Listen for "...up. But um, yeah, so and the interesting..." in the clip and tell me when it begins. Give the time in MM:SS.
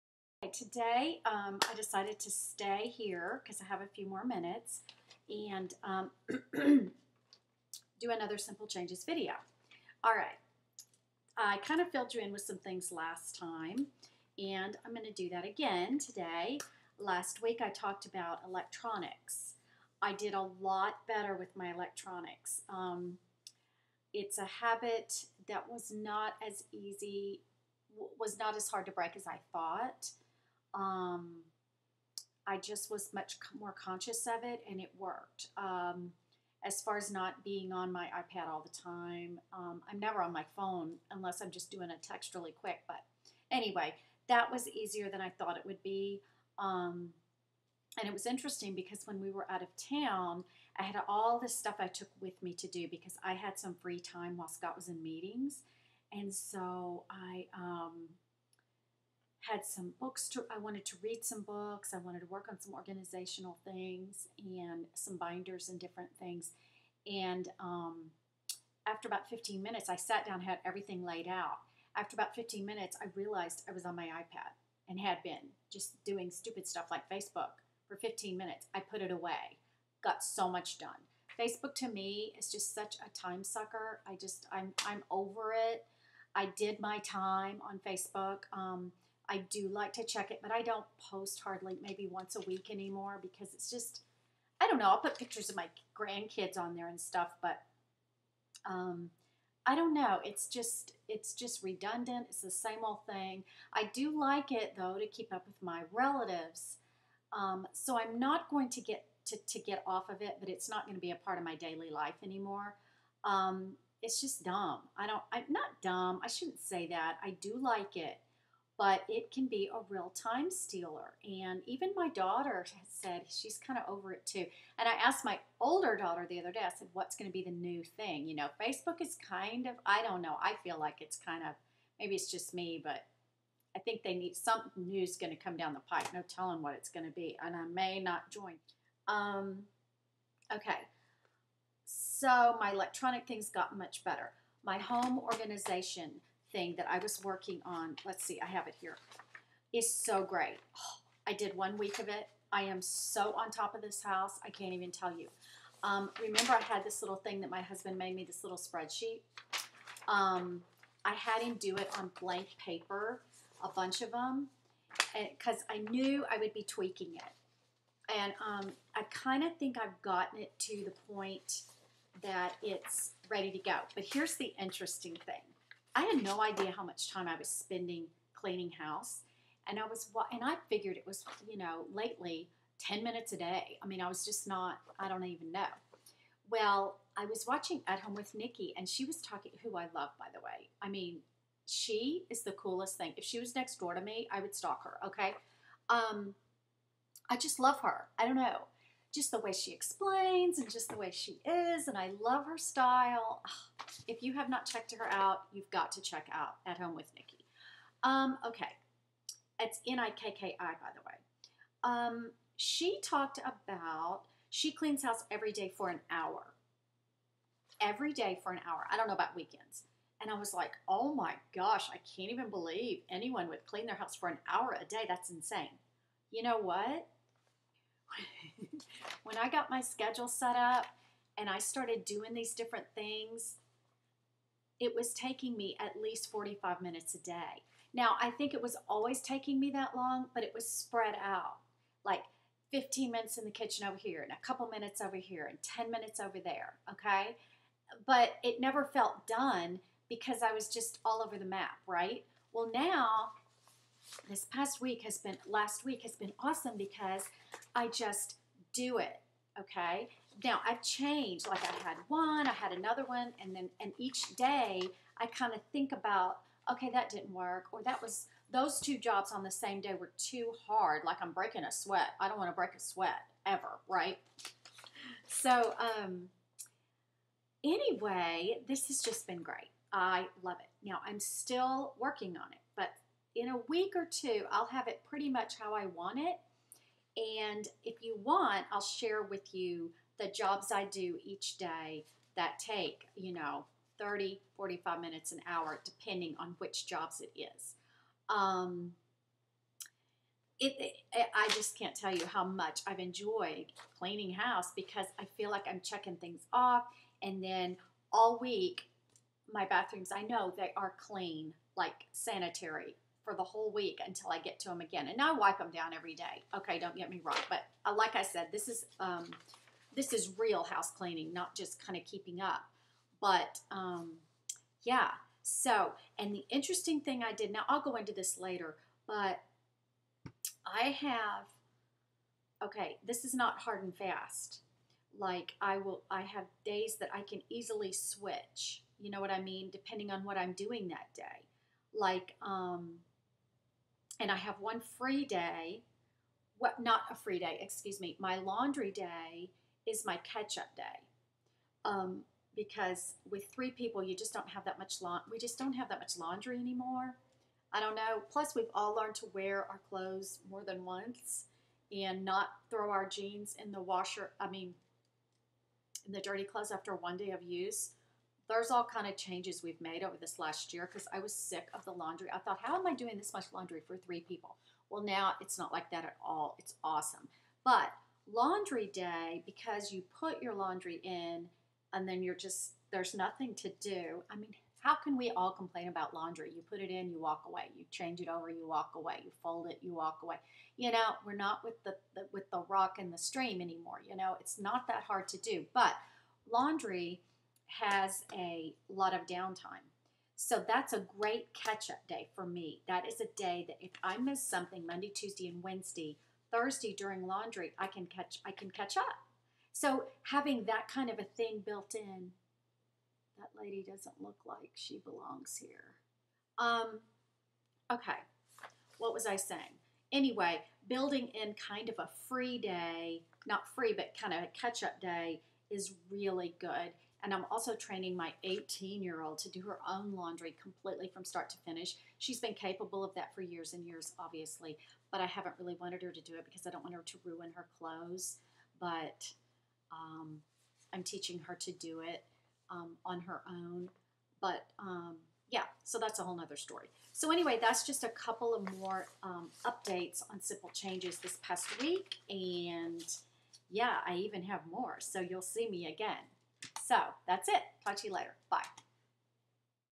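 05:22.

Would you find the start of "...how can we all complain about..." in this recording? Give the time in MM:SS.
06:24.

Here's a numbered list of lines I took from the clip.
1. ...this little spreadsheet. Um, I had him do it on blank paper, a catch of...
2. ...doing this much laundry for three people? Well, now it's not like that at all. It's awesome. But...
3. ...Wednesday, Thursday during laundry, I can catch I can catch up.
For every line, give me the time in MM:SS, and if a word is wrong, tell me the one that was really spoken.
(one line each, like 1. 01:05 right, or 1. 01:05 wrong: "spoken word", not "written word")
1. 02:38 wrong: "bunch", not "catch"
2. 06:12 right
3. 06:45 right.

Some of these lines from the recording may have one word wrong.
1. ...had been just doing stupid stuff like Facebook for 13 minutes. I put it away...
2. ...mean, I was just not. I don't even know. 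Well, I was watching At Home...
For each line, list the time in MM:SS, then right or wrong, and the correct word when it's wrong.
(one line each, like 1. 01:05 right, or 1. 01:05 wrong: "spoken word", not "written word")
1. 01:14 wrong: "15", not "13"
2. 03:03 right.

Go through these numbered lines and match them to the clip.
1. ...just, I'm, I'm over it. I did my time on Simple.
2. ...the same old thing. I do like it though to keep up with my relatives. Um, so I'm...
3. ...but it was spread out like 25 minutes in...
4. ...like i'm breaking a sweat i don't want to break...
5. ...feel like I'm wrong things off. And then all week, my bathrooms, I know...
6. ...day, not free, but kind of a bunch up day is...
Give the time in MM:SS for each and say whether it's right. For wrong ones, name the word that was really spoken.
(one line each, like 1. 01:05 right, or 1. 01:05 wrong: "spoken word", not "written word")
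1. 01:24 wrong: "Facebook", not "Simple"
2. 01:42 right
3. 04:00 wrong: "15", not "25"
4. 04:31 right
5. 05:05 wrong: "checking", not "wrong"
6. 07:02 wrong: "catch", not "bunch".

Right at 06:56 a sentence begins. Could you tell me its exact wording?
Um, okay, what was I saying?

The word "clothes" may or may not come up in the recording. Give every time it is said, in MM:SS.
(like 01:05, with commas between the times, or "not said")
05:59, 06:06, 07:17.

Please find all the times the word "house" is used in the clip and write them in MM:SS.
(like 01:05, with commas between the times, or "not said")
02:34, 02:58, 03:35, 03:43, 05:04, 05:20.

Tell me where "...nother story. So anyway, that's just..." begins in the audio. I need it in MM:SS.
07:26.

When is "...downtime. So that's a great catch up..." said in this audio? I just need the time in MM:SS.
06:39.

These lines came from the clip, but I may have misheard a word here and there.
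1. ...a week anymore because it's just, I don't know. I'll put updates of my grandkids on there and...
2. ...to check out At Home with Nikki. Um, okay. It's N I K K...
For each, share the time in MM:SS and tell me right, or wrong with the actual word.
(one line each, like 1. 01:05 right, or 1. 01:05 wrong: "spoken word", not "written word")
1. 01:32 wrong: "pictures", not "updates"
2. 03:25 right.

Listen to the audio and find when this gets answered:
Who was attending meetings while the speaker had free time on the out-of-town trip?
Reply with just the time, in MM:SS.
00:54.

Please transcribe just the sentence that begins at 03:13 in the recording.
If she was next door to me, I would stalk her.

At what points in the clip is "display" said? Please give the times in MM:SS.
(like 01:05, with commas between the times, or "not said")
not said.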